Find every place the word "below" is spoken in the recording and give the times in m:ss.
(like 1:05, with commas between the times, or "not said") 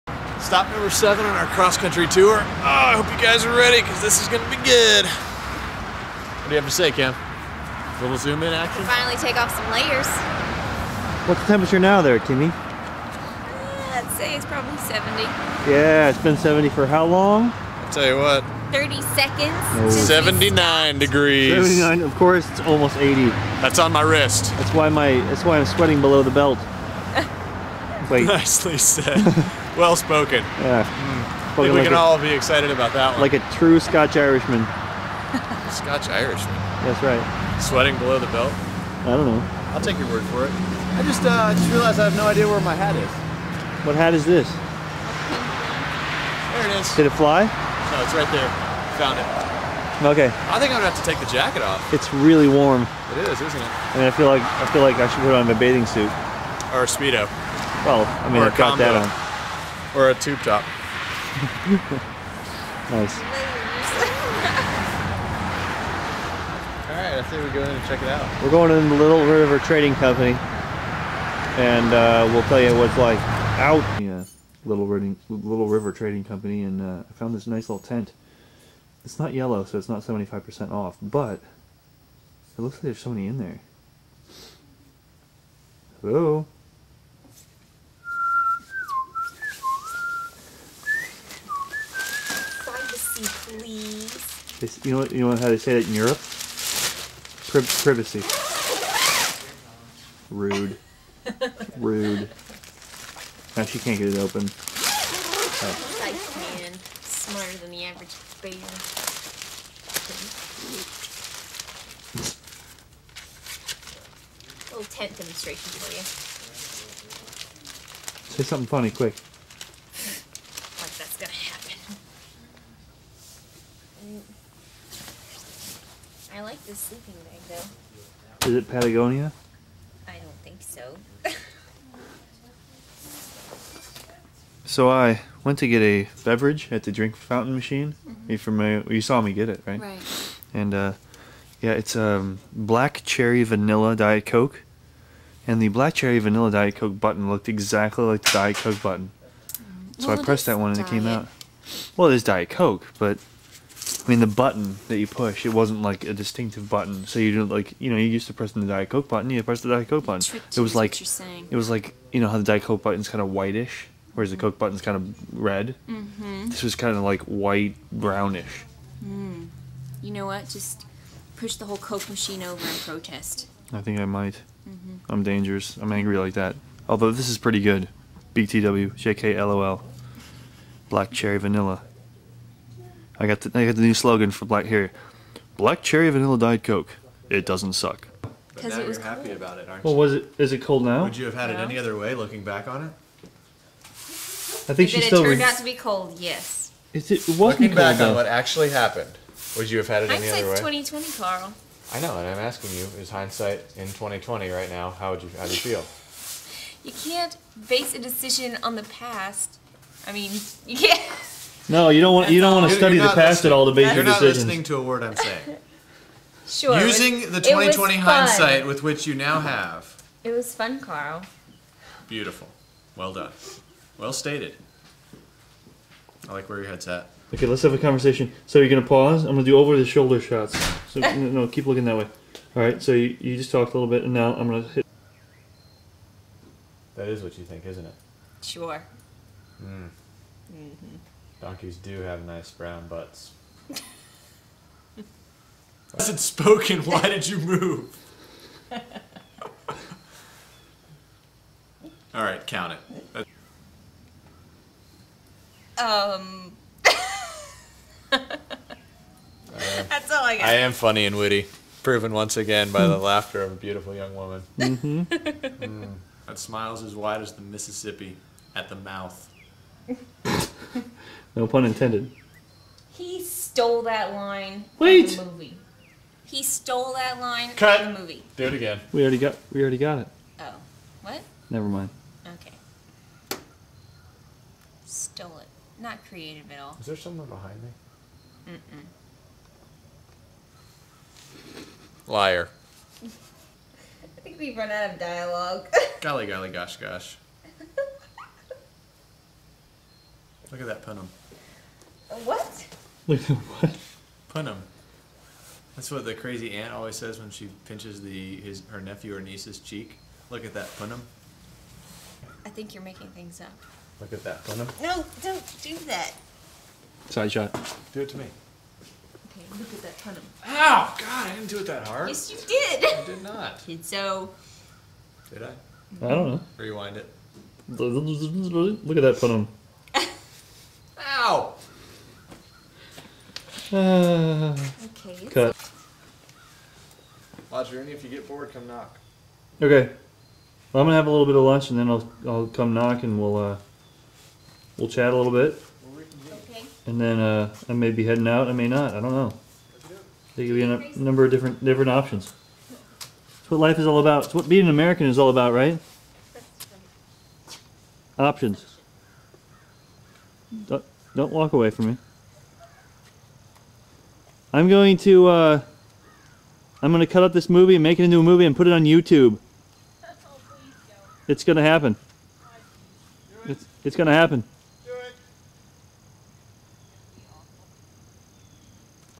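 0:26, 0:37.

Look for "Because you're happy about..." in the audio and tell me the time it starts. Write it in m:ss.
3:08.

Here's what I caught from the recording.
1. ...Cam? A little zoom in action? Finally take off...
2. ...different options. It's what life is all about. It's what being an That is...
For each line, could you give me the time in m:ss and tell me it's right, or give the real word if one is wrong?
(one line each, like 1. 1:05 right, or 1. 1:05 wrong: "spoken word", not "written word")
1. 0:06 right
2. 5:51 wrong: "American", not "That".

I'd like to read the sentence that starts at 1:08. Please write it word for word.
We're going in the Little River Trading Company, and uh, we'll tell you what's like out.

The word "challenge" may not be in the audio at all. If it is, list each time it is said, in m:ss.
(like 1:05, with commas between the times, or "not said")
not said.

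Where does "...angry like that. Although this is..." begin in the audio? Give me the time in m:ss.
2:55.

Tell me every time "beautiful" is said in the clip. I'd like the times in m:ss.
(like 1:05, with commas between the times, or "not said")
3:42, 4:23.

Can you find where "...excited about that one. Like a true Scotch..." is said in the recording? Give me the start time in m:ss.
0:32.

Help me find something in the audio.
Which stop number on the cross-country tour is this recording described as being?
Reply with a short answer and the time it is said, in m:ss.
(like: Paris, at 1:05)
7, at 0:00.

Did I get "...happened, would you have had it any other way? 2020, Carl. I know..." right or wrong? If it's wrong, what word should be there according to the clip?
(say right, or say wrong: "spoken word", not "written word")
right.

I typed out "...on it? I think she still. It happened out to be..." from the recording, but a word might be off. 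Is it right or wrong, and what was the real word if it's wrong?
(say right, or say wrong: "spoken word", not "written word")
wrong: "turned", not "happened".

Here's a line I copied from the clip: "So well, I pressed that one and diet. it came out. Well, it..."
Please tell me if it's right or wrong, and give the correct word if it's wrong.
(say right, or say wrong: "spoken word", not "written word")
right.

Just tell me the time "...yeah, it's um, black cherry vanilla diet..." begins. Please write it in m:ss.
2:21.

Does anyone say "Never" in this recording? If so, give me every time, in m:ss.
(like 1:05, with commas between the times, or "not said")
4:41.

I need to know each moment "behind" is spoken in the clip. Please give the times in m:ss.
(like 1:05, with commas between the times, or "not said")
4:47.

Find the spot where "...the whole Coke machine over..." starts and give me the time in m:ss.
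2:51.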